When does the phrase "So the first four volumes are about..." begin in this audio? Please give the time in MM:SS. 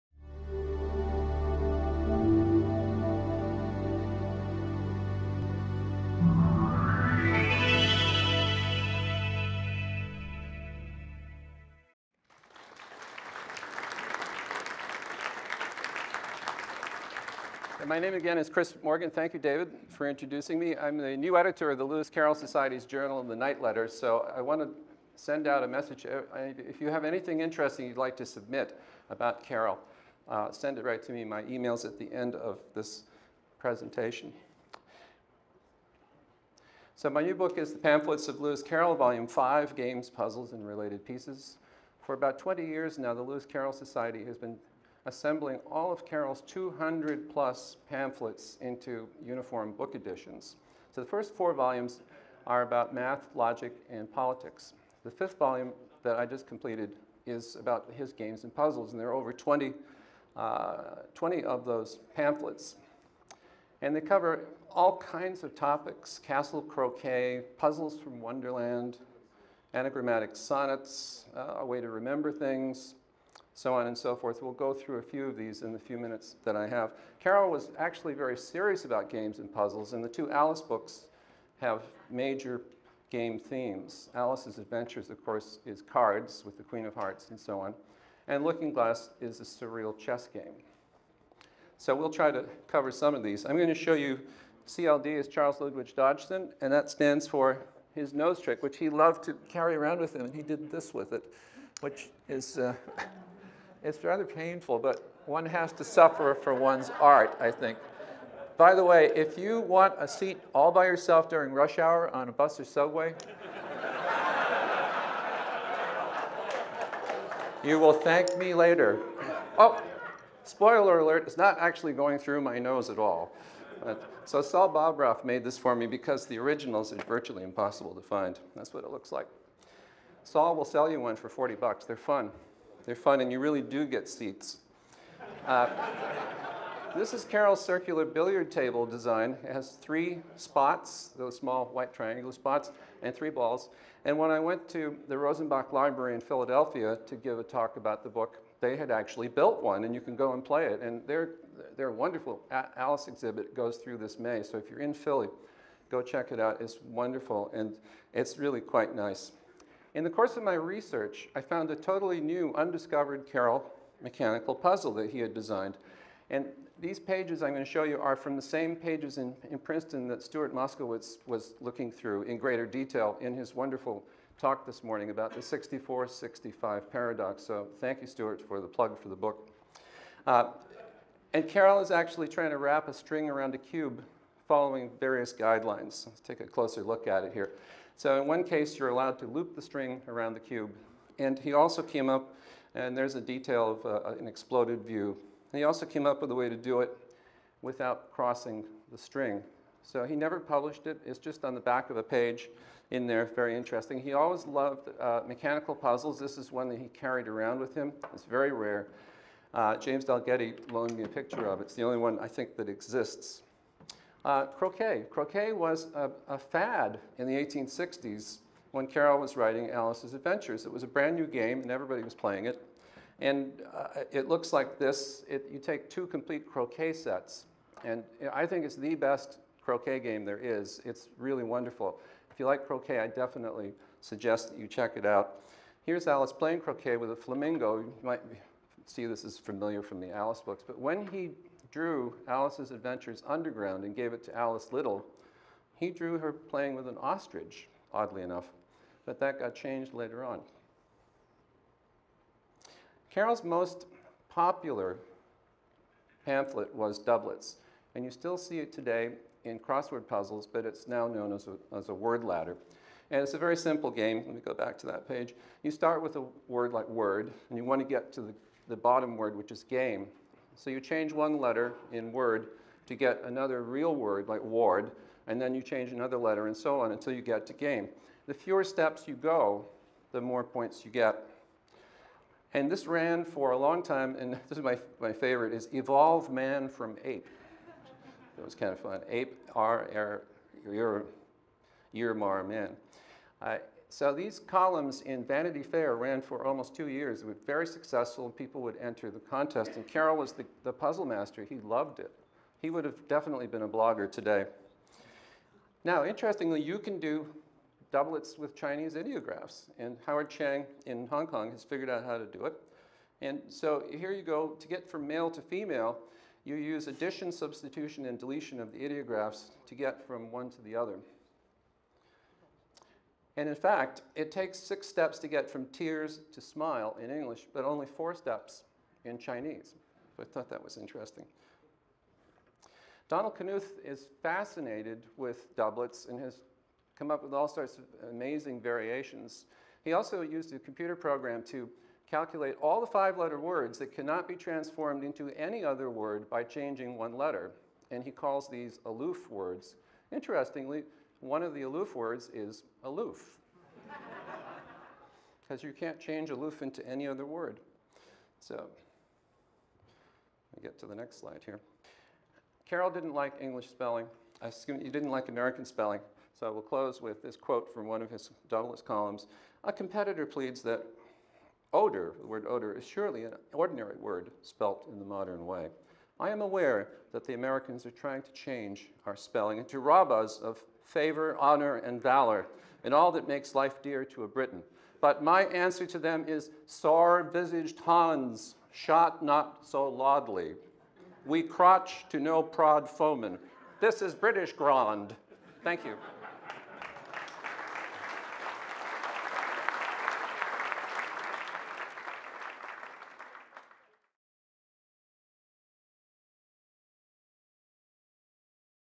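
00:50.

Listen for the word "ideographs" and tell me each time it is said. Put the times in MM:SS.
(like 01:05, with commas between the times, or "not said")
05:08, 05:18.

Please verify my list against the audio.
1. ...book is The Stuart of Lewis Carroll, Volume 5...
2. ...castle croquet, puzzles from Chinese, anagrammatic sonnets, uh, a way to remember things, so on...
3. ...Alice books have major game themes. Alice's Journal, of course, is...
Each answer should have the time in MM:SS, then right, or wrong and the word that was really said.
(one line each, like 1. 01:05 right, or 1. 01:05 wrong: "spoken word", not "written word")
1. 00:37 wrong: "Pamphlets", not "Stuart"
2. 01:06 wrong: "Wonderland", not "Chinese"
3. 01:20 wrong: "Adventures", not "Journal".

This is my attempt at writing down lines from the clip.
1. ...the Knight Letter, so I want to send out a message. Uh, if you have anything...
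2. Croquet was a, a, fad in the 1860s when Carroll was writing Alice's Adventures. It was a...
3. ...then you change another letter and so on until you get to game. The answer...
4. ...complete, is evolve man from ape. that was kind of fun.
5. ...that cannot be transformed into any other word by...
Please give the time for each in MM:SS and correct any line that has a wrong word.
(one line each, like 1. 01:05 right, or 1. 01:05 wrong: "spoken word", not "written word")
1. 00:23 right
2. 03:35 right
3. 04:35 wrong: "fewer", not "answer"
4. 04:45 wrong: "favorite", not "complete"
5. 05:43 right.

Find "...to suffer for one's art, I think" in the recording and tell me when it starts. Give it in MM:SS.
01:45.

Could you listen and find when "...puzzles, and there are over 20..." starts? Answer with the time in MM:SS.
00:58.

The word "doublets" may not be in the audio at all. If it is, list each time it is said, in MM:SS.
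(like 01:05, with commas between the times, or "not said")
04:16, 05:07, 05:35, 06:08.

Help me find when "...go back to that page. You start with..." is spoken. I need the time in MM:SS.
04:24.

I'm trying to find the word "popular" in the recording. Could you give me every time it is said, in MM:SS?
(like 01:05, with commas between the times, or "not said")
04:14.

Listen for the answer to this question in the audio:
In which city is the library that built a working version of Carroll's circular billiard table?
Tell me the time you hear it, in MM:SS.
02:26.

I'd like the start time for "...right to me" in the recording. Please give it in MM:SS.
00:30.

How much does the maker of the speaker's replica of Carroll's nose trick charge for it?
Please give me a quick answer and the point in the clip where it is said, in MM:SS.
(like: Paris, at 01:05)
$40, at 02:11.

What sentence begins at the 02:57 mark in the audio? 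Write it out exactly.
So thank you, Stuart, for the plug for the book.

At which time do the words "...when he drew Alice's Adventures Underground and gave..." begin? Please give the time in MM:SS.
04:00.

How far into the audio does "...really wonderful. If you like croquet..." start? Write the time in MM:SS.
03:51.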